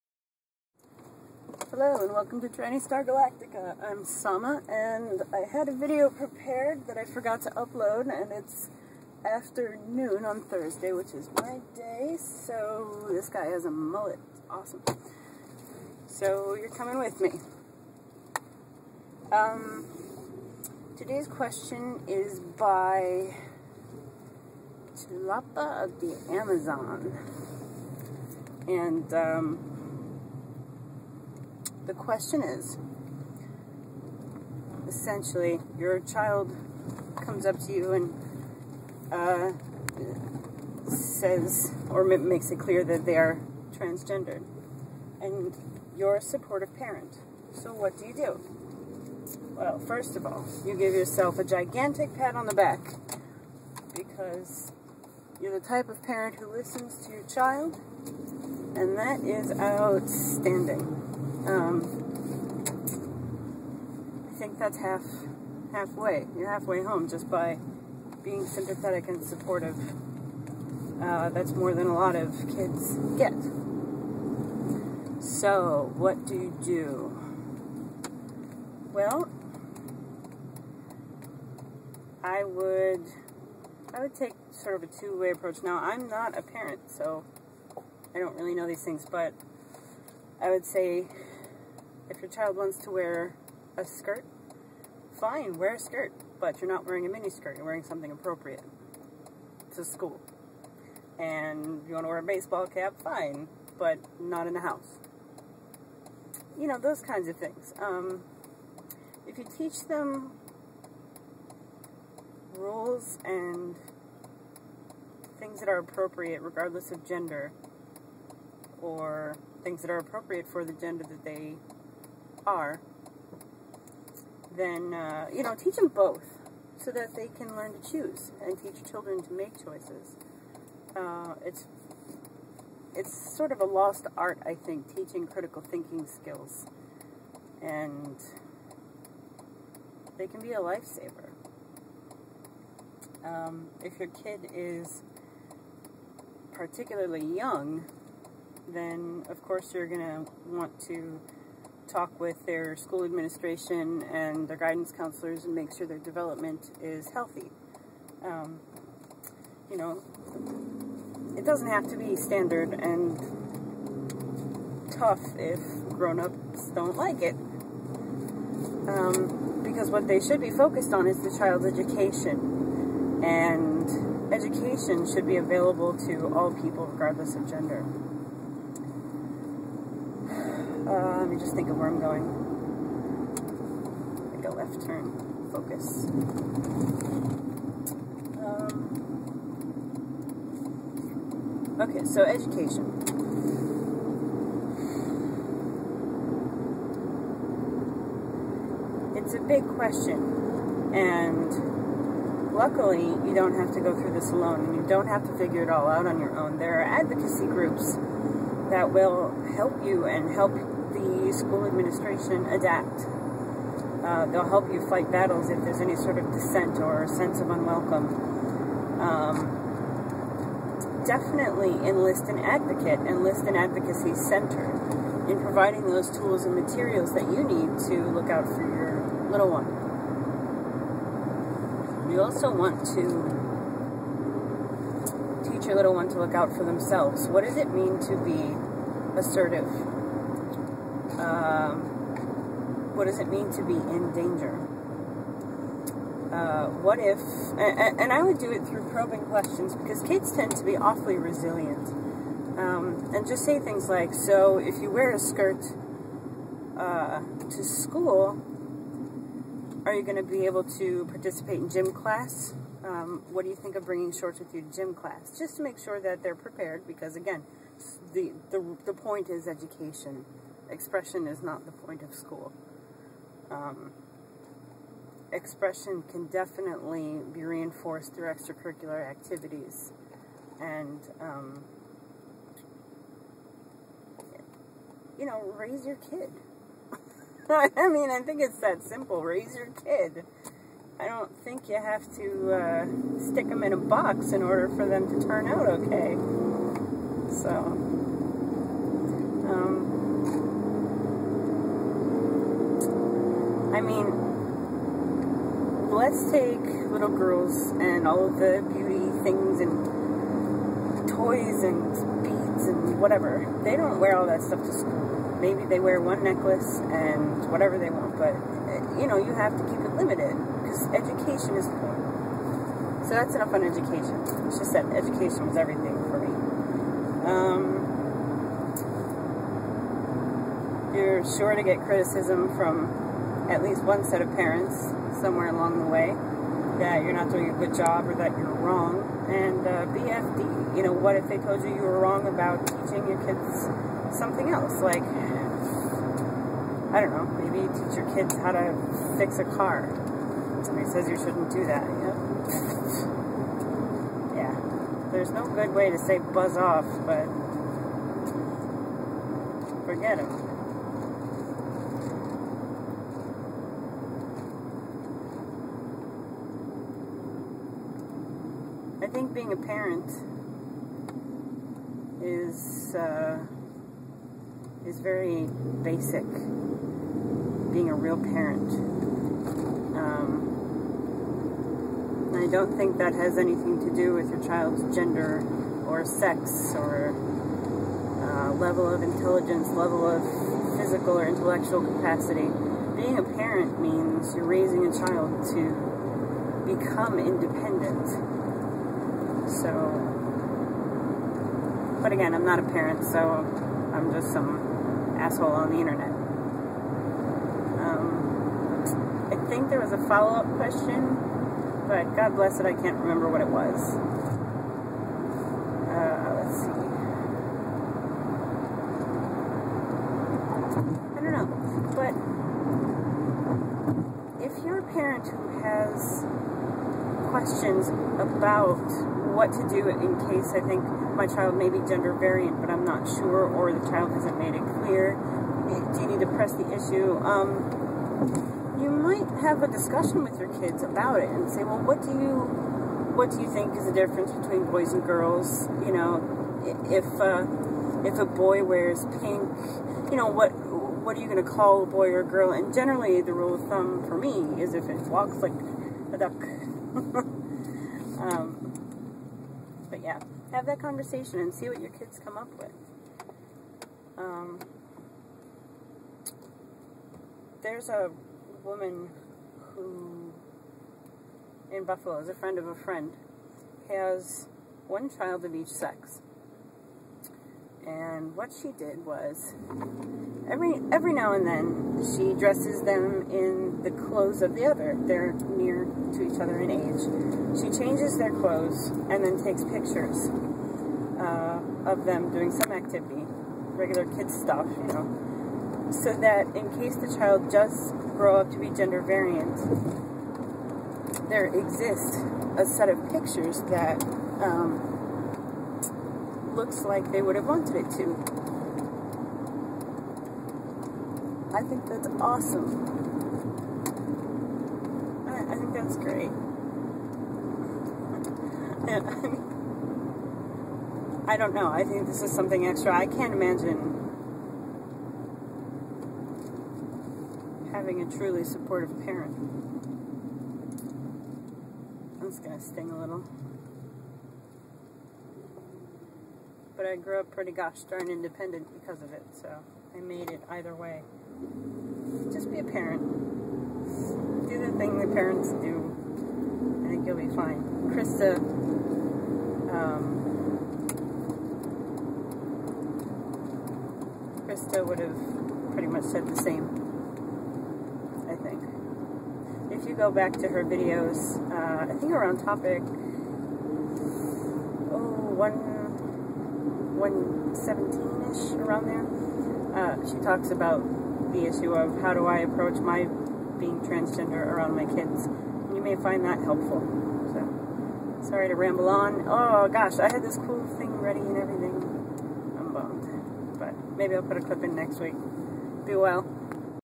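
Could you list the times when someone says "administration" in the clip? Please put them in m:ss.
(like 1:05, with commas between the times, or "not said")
2:33, 3:31.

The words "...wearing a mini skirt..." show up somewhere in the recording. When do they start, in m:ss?
1:36.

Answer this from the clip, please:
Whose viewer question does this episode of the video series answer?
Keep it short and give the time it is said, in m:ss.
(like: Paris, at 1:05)
Chilapa of the Amazon, at 0:24.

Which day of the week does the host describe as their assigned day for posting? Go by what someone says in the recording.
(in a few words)
Thursday.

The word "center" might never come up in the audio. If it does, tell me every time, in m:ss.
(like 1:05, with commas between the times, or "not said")
3:44.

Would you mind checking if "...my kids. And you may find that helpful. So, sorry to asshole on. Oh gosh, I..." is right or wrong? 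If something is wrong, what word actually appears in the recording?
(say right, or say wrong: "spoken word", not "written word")
wrong: "ramble", not "asshole".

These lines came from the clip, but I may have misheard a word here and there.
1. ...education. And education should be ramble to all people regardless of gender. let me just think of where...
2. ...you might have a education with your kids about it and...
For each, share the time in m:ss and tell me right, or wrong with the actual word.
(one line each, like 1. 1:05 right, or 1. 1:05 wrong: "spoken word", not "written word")
1. 2:51 wrong: "available", not "ramble"
2. 7:18 wrong: "discussion", not "education".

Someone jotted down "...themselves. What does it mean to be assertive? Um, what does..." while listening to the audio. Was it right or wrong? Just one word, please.
right.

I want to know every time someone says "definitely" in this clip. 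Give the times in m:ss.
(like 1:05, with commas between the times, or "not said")
3:41, 4:36.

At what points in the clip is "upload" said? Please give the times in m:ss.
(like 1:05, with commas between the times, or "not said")
0:07.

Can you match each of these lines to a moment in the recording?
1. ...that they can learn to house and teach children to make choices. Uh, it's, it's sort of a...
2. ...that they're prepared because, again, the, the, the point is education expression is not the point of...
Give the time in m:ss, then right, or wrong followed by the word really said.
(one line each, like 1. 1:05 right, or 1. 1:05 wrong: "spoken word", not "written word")
1. 2:06 wrong: "choose", not "house"
2. 4:25 right.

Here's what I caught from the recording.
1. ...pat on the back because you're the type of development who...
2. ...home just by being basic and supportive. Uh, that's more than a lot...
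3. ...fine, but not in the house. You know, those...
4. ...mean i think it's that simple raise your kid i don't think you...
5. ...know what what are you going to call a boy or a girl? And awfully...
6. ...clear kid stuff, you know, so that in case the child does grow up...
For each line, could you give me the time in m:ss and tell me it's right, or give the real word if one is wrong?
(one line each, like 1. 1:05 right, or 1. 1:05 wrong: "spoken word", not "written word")
1. 0:52 wrong: "parent", not "development"
2. 1:06 wrong: "sympathetic", not "basic"
3. 1:43 right
4. 4:47 right
5. 7:30 wrong: "generally", not "awfully"
6. 8:13 wrong: "regular", not "clear".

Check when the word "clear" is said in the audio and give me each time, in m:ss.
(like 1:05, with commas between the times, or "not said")
0:42, 7:14.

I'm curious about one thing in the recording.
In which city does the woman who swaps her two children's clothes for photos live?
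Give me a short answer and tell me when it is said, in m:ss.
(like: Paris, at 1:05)
Buffalo, at 7:51.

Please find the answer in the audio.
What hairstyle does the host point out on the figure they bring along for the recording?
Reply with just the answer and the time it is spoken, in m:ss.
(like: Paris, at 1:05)
Mullet, at 0:13.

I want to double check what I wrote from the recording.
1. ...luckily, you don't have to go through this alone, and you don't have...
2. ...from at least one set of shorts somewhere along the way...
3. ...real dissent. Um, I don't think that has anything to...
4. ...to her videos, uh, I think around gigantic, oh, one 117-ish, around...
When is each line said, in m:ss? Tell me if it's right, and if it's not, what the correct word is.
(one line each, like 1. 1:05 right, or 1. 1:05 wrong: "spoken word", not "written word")
1. 3:22 right
2. 5:32 wrong: "parents", not "shorts"
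3. 6:17 wrong: "parent", not "dissent"
4. 9:20 wrong: "topic", not "gigantic".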